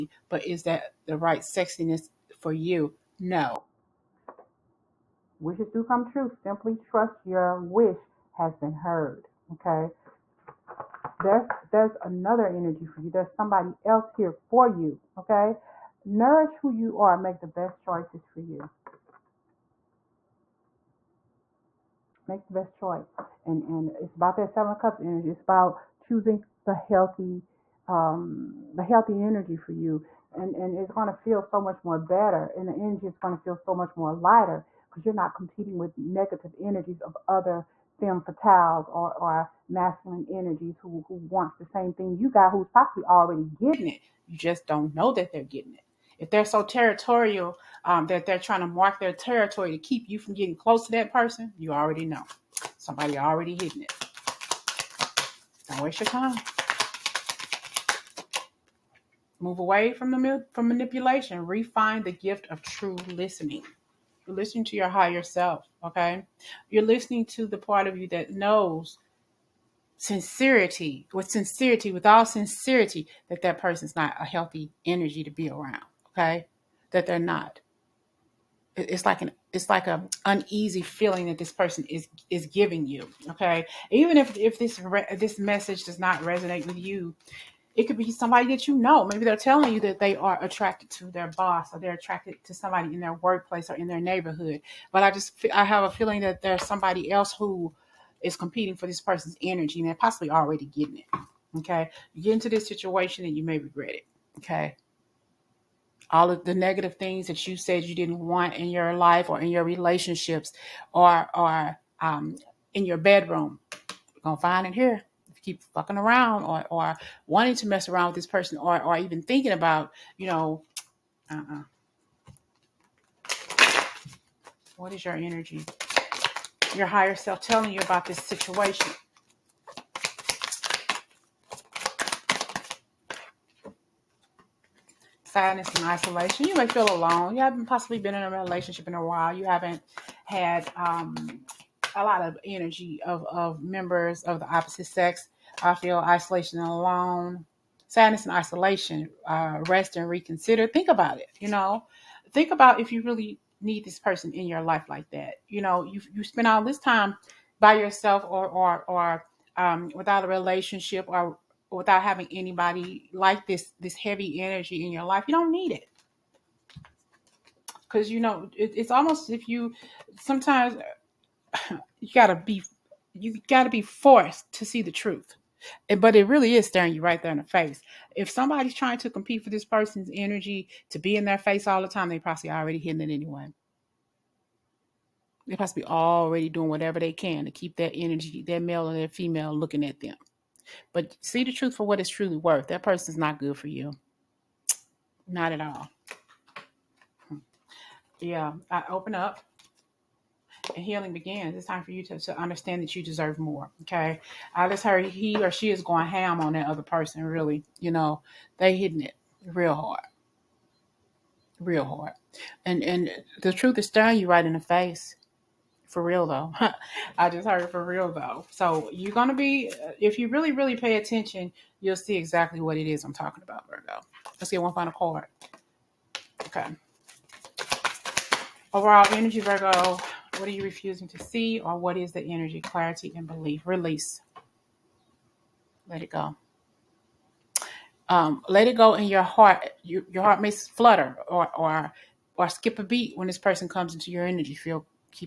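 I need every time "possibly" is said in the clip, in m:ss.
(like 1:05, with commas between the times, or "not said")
0:42, 1:39, 2:17, 3:05.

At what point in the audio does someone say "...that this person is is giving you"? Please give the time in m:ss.
1:21.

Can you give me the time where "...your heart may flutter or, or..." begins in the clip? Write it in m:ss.
4:00.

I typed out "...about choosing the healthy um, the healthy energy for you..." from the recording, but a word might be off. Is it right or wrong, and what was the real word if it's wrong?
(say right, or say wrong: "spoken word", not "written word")
right.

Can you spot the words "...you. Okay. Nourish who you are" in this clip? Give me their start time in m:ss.
0:14.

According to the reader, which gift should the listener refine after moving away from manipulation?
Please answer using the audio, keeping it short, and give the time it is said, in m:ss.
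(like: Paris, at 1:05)
True listening, at 1:02.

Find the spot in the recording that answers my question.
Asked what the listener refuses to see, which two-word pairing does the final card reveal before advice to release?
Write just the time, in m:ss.
3:52.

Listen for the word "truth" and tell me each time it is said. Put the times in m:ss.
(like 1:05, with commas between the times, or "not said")
2:54, 3:11, 3:33.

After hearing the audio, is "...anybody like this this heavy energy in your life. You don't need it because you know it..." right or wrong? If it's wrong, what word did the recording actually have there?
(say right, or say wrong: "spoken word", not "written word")
right.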